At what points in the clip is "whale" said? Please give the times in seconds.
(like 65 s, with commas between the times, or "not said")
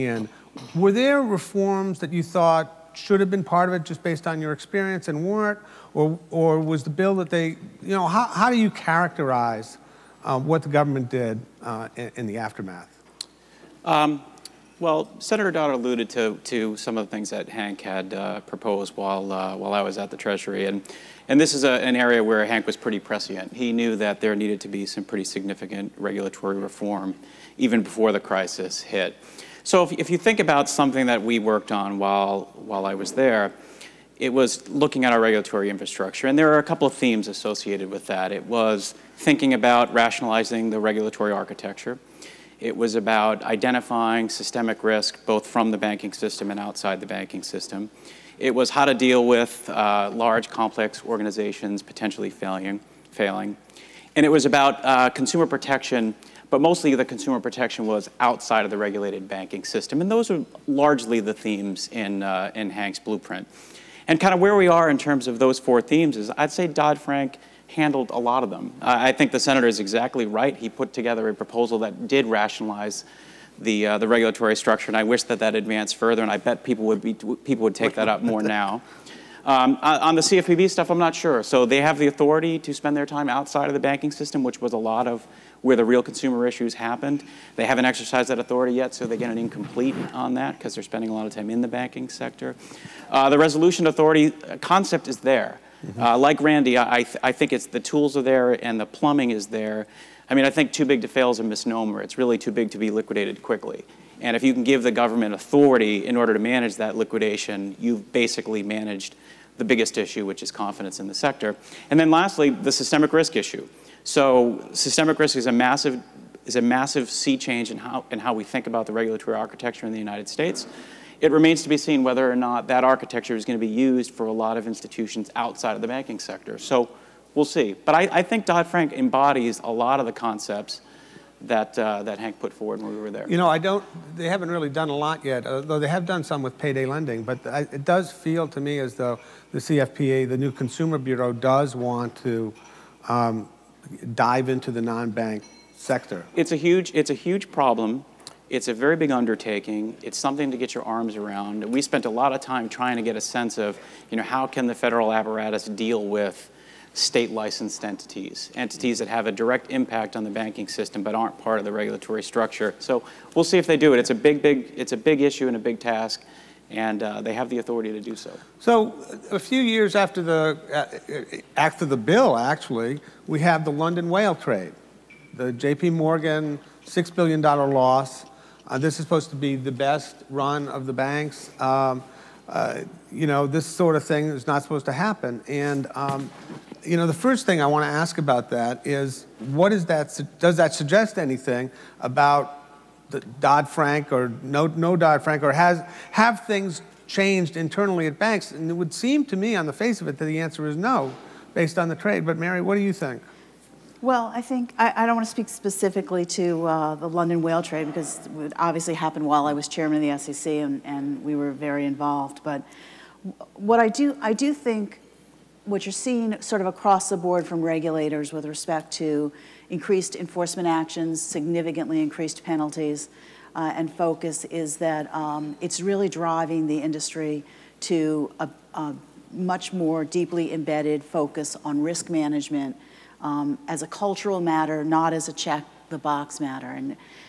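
174 s, 207 s.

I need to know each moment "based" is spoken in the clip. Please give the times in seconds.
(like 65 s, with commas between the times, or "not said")
4 s, 201 s.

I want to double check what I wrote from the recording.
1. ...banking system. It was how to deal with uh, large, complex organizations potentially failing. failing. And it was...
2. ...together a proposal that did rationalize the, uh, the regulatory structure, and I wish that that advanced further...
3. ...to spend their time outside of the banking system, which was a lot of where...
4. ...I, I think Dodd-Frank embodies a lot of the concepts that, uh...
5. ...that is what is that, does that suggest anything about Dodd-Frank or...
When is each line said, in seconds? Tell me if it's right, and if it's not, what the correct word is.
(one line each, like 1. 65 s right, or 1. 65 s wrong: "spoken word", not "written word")
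1. 47 s right
2. 70 s right
3. 82 s right
4. 127 s right
5. 188 s right.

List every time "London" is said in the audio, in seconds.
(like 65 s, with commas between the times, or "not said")
173 s, 207 s.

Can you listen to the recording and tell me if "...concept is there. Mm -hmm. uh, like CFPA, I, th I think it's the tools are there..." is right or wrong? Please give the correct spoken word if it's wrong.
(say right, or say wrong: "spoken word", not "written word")
wrong: "Randy", not "CFPA".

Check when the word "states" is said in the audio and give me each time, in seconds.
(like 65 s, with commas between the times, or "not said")
120 s, 156 s.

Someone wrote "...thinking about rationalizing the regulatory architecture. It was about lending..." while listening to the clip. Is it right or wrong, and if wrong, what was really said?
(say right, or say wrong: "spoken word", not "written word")
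wrong: "identifying", not "lending".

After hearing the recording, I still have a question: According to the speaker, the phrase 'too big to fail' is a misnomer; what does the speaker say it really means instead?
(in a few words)
Too big to be liquidated quickly.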